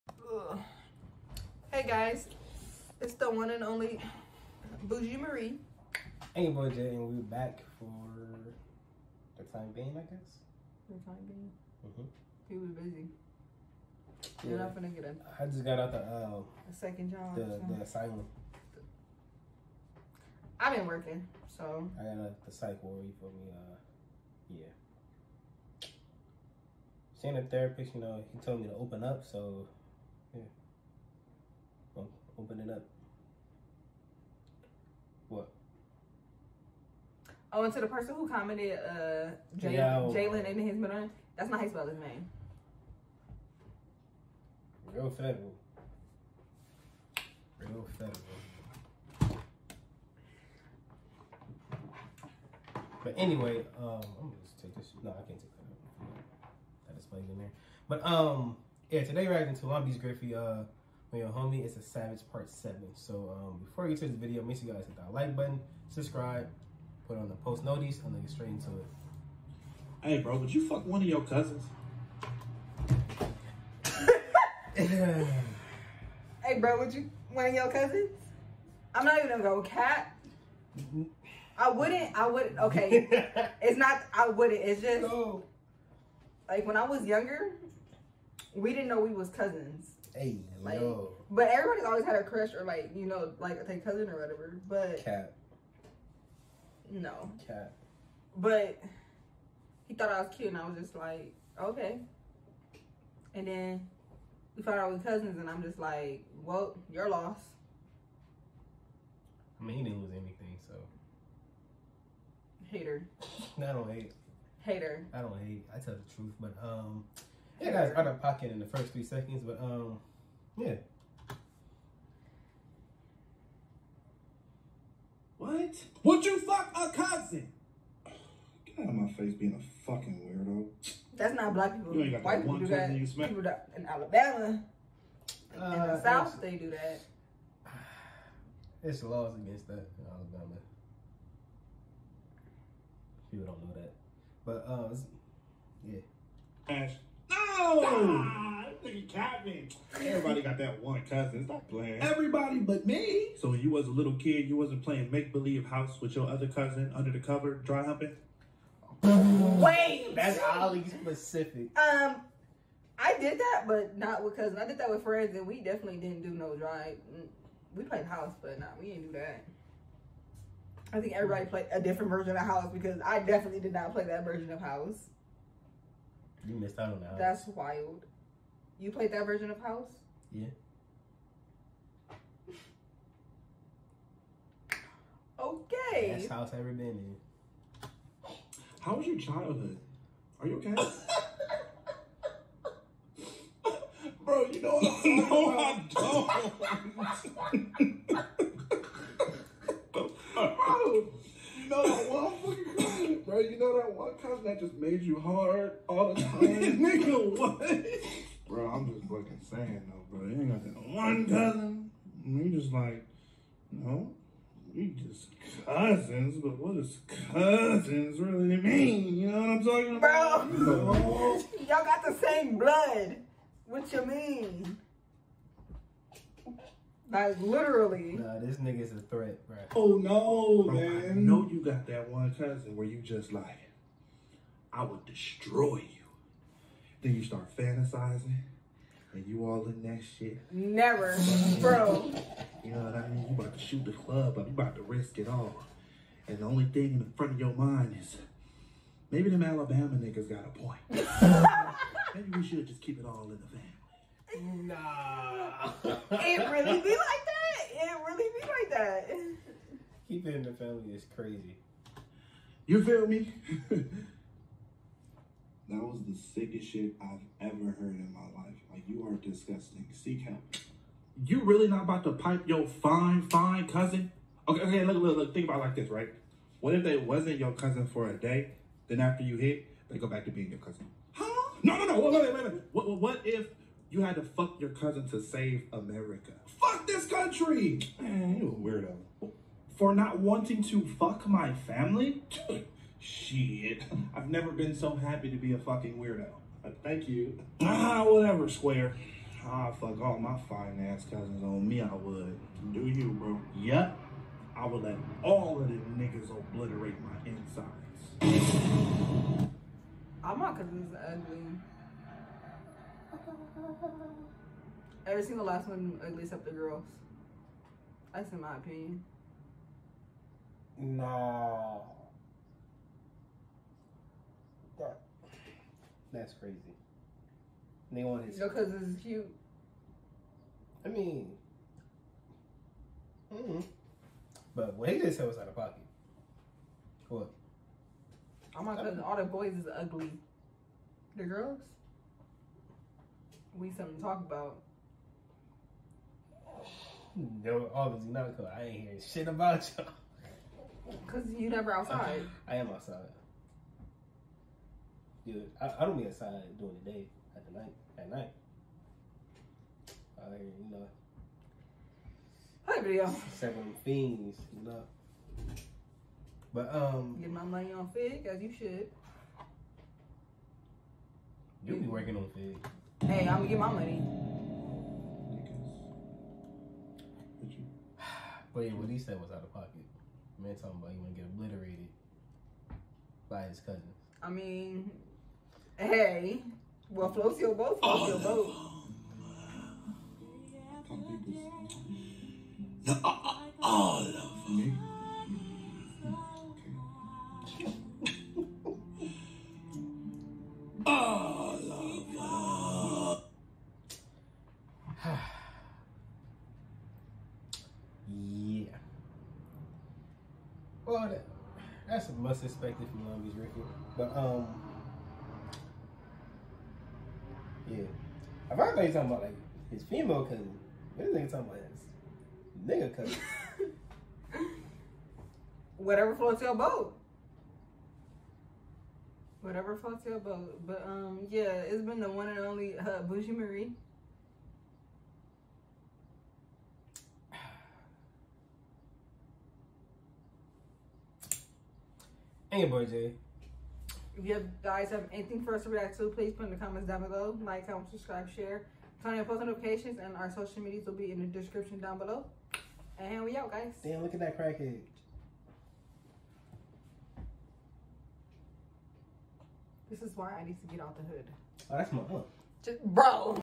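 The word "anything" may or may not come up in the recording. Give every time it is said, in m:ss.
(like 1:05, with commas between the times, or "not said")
1:50, 7:25.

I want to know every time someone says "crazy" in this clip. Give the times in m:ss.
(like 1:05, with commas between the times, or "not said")
4:21, 5:26.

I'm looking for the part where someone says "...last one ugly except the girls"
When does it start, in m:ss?
5:15.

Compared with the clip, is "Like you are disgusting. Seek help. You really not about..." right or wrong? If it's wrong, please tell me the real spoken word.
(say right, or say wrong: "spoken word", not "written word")
right.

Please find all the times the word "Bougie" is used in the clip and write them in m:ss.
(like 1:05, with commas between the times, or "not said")
0:04, 7:13.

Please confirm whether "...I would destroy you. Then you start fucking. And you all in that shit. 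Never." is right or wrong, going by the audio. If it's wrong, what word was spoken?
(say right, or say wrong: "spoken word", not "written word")
wrong: "fantasizing", not "fucking".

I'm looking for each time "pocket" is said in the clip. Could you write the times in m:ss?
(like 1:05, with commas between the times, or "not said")
1:58, 5:35, 6:19.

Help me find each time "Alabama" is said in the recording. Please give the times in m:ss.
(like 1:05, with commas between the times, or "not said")
2:13, 2:20, 4:09.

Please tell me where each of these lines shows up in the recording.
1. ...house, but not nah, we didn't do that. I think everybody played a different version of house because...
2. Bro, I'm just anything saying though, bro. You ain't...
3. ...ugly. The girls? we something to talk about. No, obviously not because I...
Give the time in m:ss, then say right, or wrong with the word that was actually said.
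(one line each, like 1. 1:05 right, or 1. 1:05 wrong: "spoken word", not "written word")
1. 2:48 right
2. 3:28 wrong: "fucking", not "anything"
3. 5:39 right.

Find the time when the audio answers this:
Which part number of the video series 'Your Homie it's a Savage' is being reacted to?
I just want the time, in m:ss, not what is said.
1:02.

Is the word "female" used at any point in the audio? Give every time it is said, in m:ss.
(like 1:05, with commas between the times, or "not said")
6:59.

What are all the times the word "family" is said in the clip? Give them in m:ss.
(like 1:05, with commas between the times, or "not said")
4:13, 4:20, 4:51.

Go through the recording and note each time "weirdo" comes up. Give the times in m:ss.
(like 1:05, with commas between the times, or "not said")
2:10, 4:48, 4:55.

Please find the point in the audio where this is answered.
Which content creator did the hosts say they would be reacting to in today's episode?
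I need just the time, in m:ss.
0:59.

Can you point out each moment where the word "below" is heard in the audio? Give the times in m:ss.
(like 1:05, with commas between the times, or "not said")
7:27, 7:31.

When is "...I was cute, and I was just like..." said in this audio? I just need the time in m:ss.
1:40.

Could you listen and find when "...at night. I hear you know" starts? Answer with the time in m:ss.
5:57.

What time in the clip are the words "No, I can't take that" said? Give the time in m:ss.
0:55.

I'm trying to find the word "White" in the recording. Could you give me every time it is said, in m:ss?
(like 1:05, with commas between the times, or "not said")
2:12.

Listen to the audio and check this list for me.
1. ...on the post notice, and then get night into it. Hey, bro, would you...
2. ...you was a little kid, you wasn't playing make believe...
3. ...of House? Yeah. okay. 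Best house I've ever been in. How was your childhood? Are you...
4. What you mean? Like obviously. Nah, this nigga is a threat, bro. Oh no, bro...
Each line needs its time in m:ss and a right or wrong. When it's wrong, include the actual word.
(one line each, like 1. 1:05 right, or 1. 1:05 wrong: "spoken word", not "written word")
1. 1:07 wrong: "straight", not "night"
2. 2:33 right
3. 2:59 right
4. 3:43 wrong: "literally", not "obviously".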